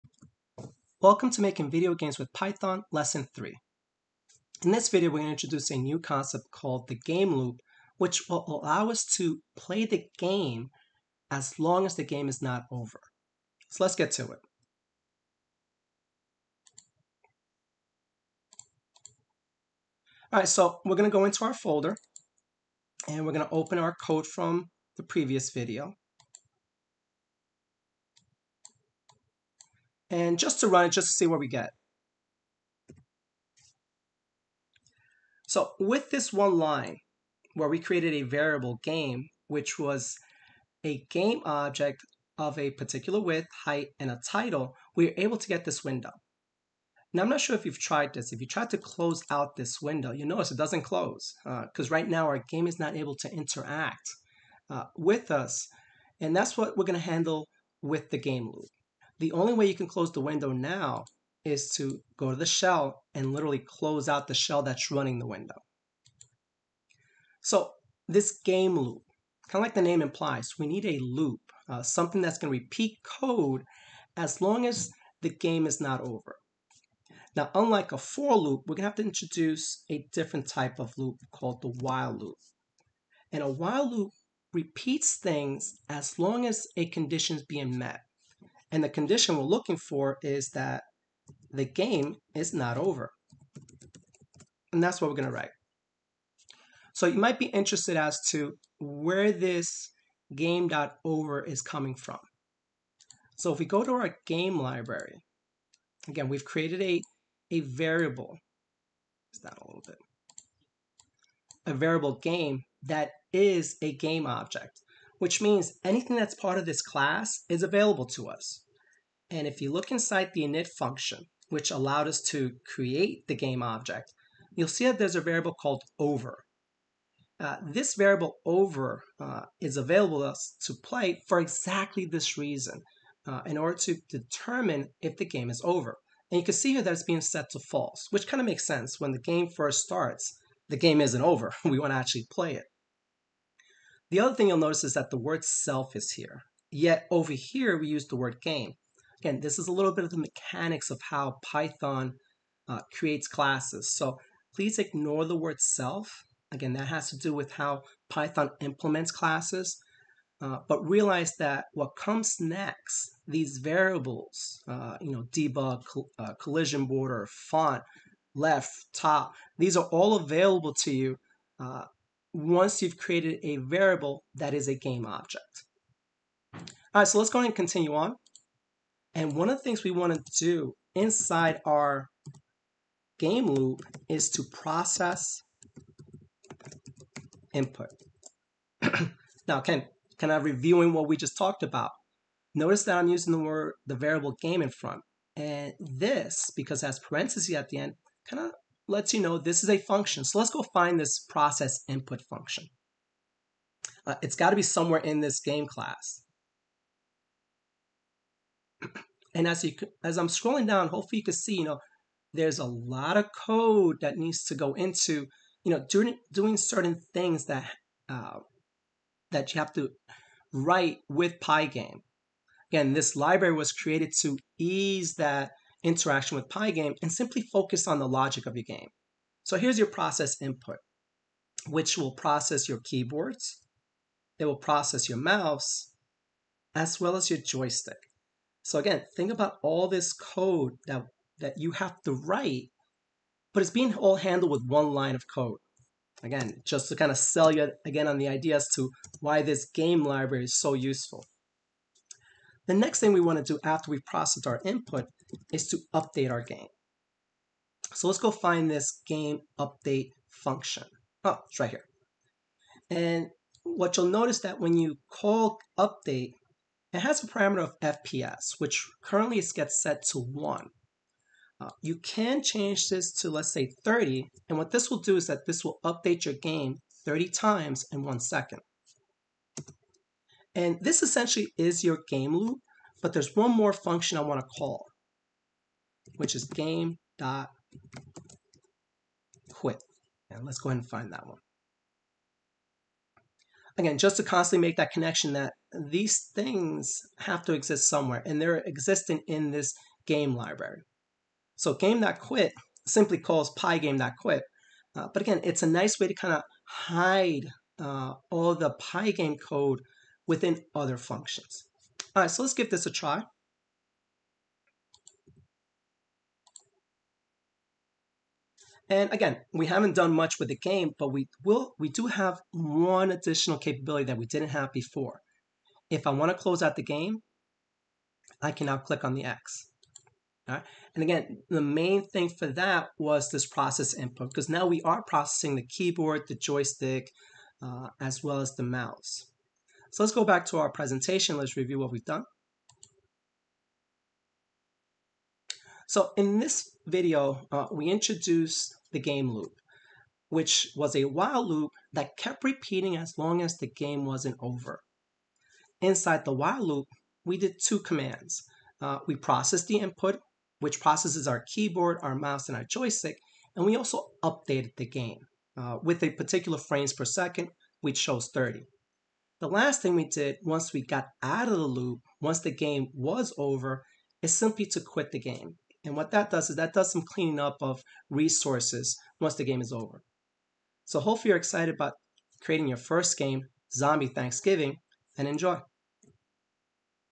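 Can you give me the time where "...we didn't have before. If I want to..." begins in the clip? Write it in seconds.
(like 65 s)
324 s.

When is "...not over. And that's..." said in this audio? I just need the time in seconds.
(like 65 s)
92 s.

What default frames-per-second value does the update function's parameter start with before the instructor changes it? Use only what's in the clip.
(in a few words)
1.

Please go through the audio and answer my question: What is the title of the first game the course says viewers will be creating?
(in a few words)
Zombie Thanksgiving.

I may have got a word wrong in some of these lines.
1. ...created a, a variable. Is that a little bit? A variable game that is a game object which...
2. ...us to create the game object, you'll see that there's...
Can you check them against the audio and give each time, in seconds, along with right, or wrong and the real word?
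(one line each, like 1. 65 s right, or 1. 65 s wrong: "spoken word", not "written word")
1. 106 s right
2. 122 s right.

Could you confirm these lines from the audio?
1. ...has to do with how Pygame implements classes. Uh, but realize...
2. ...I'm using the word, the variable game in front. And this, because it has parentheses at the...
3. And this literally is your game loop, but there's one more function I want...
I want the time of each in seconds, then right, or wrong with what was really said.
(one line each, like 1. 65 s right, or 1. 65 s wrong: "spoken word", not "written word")
1. 156 s wrong: "Python", not "Pygame"
2. 192 s right
3. 280 s wrong: "essentially", not "literally".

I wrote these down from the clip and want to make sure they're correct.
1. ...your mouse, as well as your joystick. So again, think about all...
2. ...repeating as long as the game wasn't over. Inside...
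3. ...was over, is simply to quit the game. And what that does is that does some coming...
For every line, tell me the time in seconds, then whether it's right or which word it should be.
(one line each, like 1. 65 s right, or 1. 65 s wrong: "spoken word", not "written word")
1. 235 s right
2. 352 s right
3. 372 s wrong: "cleaning", not "coming".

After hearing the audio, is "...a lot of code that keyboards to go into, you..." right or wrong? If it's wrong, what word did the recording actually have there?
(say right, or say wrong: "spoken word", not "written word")
wrong: "needs", not "keyboards".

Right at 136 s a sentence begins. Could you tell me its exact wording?
And you can see here that it's being set to false, which kind of makes sense.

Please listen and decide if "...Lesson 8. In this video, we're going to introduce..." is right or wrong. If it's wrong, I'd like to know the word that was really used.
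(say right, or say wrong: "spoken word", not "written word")
wrong: "3", not "8".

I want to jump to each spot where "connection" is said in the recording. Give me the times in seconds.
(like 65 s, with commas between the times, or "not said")
294 s.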